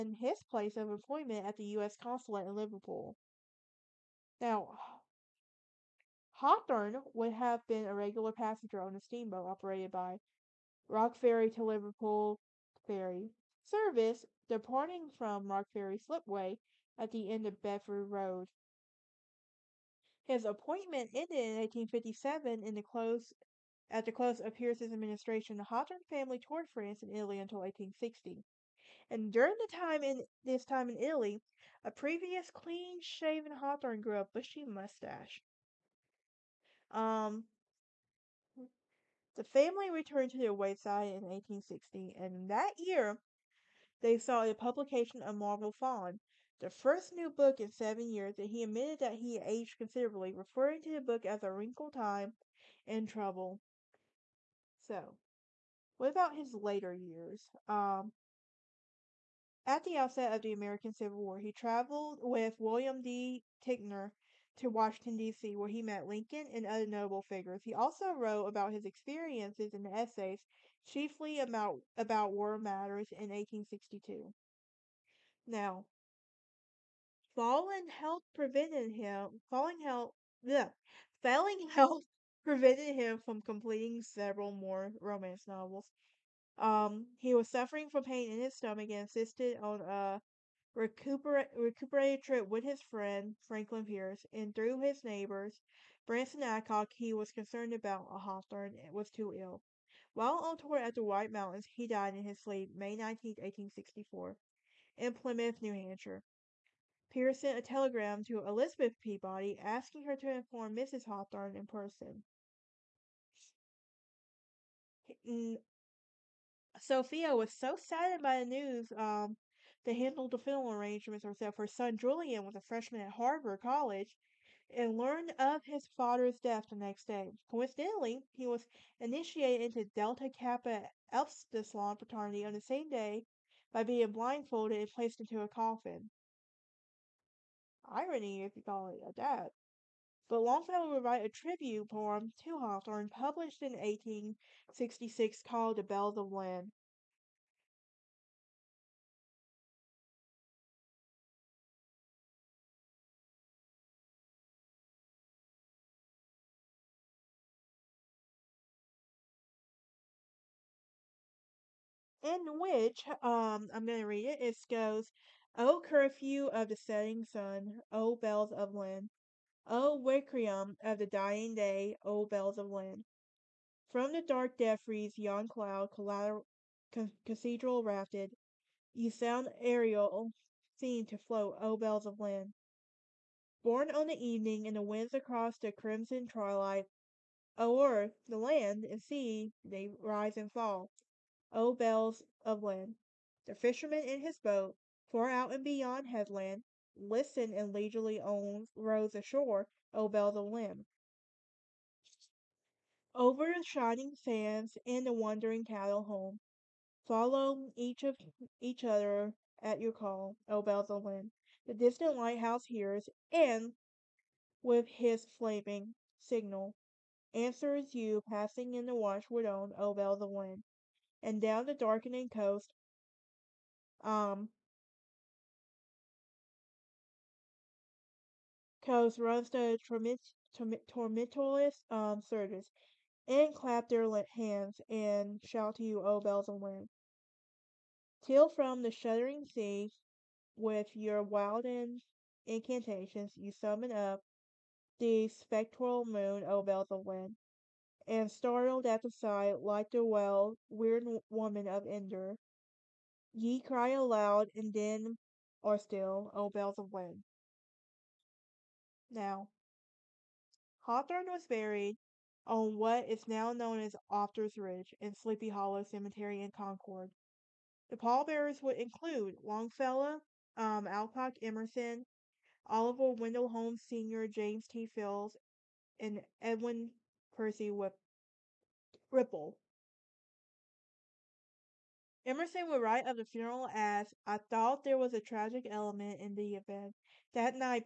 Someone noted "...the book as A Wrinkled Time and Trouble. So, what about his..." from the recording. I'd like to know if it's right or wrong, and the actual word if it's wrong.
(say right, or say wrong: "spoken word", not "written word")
right.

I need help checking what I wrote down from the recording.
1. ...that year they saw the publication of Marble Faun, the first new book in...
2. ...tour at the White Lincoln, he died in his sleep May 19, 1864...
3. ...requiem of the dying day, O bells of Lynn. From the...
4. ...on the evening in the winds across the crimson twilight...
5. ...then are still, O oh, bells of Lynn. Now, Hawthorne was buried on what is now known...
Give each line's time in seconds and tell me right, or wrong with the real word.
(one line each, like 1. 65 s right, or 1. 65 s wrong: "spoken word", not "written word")
1. 42 s right
2. 100 s wrong: "Mountains", not "Lincoln"
3. 170 s right
4. 183 s right
5. 254 s right.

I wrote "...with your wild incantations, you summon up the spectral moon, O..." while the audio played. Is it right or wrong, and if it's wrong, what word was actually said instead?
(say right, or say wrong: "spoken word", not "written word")
right.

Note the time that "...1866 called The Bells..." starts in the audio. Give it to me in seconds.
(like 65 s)
143 s.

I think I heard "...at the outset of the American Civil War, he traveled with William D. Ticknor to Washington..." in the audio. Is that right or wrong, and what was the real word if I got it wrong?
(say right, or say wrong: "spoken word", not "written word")
right.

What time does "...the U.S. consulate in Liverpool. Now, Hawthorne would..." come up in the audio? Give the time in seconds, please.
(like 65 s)
1 s.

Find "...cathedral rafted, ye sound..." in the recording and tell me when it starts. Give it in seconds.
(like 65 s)
177 s.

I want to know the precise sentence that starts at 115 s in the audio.
Mm, Sophia was so saddened by the news um, to handle the funeral arrangements herself.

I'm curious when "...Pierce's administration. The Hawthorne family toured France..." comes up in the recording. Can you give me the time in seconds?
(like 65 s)
24 s.